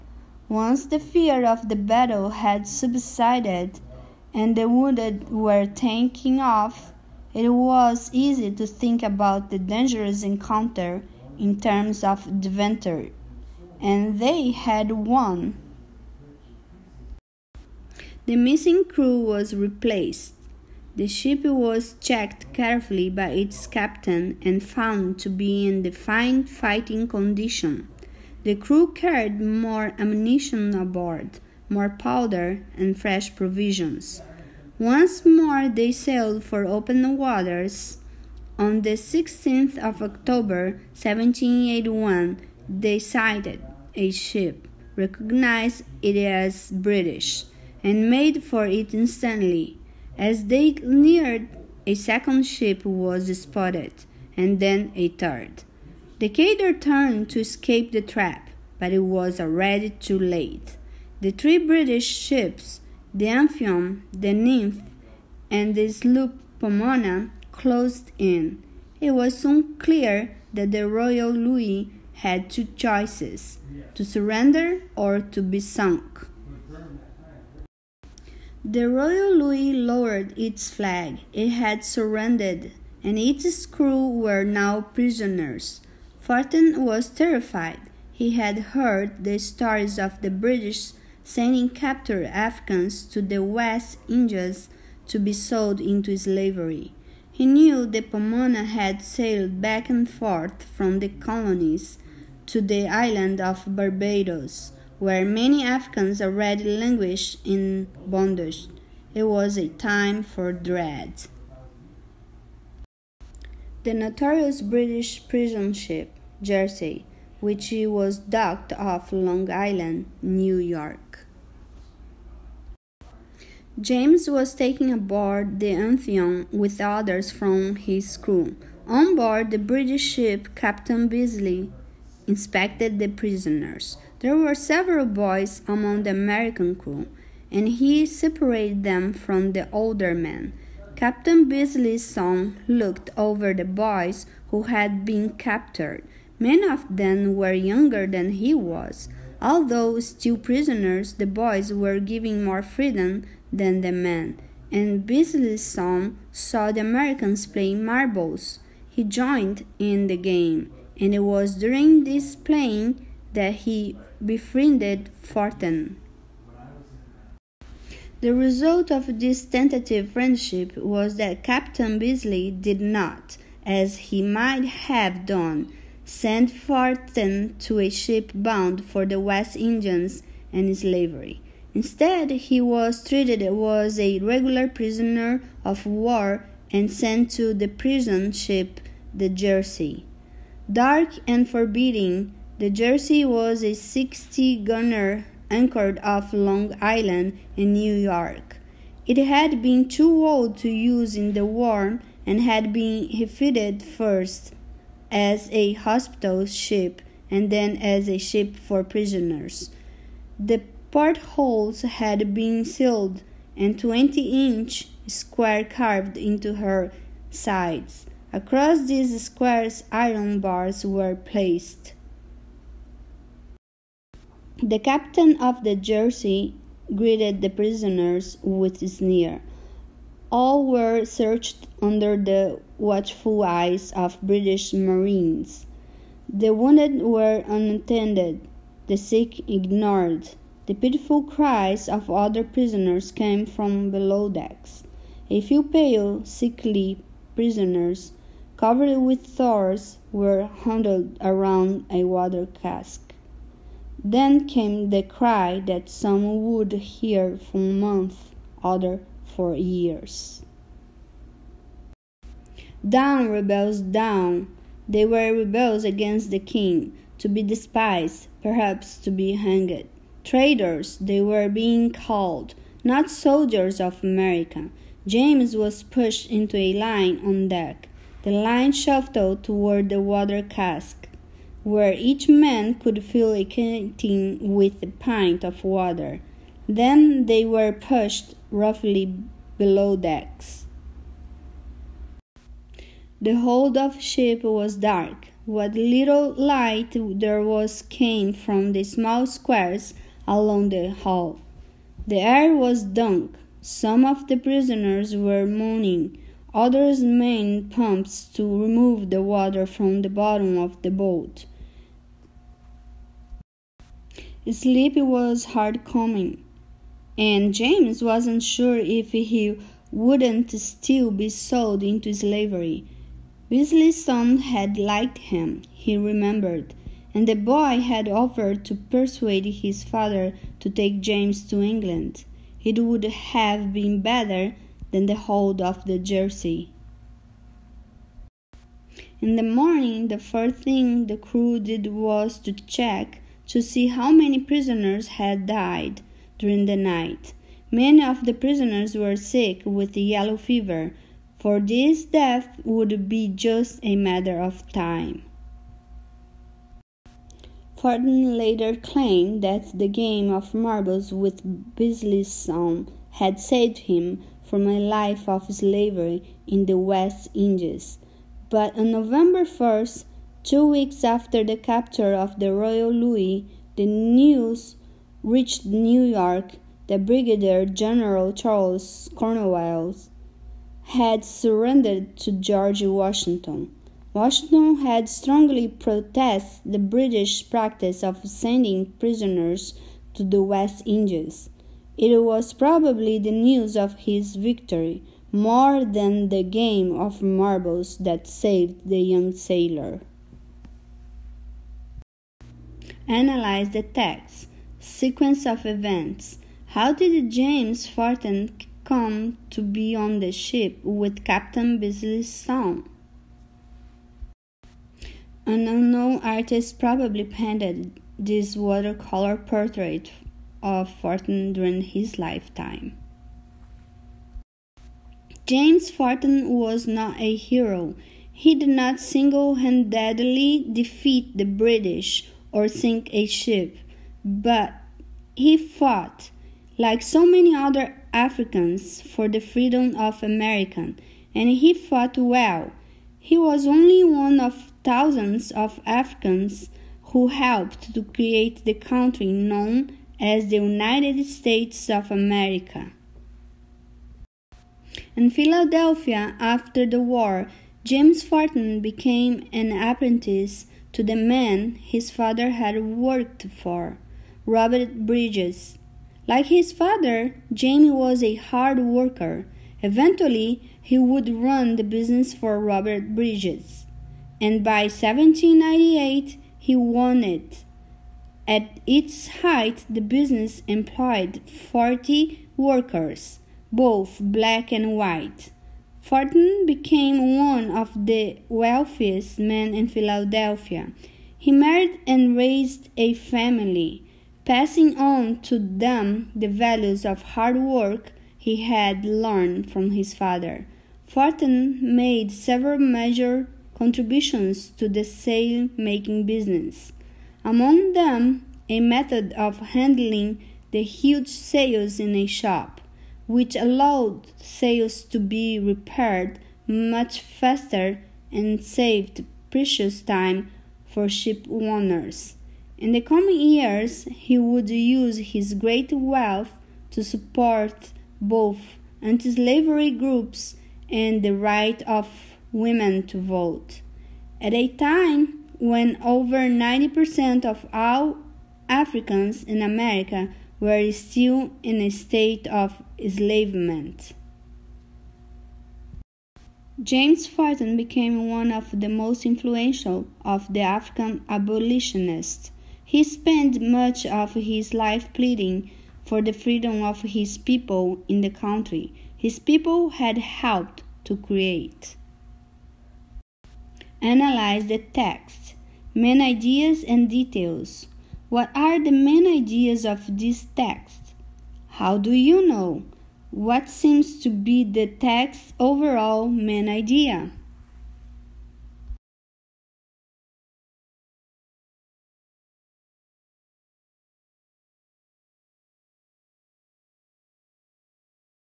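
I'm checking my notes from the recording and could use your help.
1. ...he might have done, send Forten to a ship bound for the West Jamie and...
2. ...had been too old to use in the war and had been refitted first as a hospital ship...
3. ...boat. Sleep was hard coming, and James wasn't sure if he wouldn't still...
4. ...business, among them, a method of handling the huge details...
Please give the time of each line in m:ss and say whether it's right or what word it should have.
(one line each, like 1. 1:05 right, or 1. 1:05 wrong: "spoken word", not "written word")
1. 2:54 wrong: "Indians", not "Jamie"
2. 3:19 right
3. 5:10 right
4. 8:26 wrong: "sails", not "details".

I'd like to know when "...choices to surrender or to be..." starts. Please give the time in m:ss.
1:12.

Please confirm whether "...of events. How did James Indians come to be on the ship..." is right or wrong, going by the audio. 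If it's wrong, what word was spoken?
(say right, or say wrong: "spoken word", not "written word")
wrong: "Forten", not "Indians".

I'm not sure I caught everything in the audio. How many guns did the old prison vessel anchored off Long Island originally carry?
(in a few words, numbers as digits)
60.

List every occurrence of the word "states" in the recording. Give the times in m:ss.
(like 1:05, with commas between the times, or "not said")
7:31, 9:01.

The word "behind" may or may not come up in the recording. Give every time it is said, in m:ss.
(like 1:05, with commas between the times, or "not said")
not said.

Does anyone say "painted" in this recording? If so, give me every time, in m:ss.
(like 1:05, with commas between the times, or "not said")
6:57.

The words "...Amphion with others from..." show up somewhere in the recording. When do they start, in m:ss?
2:05.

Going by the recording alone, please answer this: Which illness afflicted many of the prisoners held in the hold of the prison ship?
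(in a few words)
Yellow fever.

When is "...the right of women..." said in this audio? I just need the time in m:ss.
8:51.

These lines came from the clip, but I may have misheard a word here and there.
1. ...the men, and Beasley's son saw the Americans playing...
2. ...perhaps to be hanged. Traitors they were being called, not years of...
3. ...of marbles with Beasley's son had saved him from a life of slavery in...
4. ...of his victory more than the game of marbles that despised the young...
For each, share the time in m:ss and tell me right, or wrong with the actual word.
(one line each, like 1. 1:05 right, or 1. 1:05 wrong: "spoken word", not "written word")
1. 2:33 right
2. 4:28 wrong: "soldiers", not "years"
3. 6:00 right
4. 6:33 wrong: "saved", not "despised".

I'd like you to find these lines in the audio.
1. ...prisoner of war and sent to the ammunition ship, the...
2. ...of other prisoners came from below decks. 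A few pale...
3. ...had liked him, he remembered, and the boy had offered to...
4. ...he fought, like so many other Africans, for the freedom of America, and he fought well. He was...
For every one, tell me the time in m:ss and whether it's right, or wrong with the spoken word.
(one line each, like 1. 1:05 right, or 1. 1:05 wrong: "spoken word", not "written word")
1. 3:04 wrong: "prison", not "ammunition"
2. 4:01 right
3. 5:24 right
4. 7:15 right.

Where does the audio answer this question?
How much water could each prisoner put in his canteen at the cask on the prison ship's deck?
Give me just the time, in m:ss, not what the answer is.
4:44.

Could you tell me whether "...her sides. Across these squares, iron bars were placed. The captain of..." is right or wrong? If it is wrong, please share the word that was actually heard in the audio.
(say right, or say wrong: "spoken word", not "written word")
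right.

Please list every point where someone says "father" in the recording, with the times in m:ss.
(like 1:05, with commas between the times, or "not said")
5:29, 7:42, 7:46, 8:20.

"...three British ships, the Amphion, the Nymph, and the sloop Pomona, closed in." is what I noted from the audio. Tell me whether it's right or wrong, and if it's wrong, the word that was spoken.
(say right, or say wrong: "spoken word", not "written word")
right.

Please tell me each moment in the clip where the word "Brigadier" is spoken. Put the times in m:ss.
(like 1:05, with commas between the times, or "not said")
6:17.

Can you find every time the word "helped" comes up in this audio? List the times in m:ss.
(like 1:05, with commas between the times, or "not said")
7:27, 9:20.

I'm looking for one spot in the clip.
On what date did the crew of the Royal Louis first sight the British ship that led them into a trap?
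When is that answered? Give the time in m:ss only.
0:38.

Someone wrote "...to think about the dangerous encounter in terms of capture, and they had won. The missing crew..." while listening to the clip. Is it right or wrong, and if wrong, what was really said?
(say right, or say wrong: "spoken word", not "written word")
wrong: "adventure", not "capture".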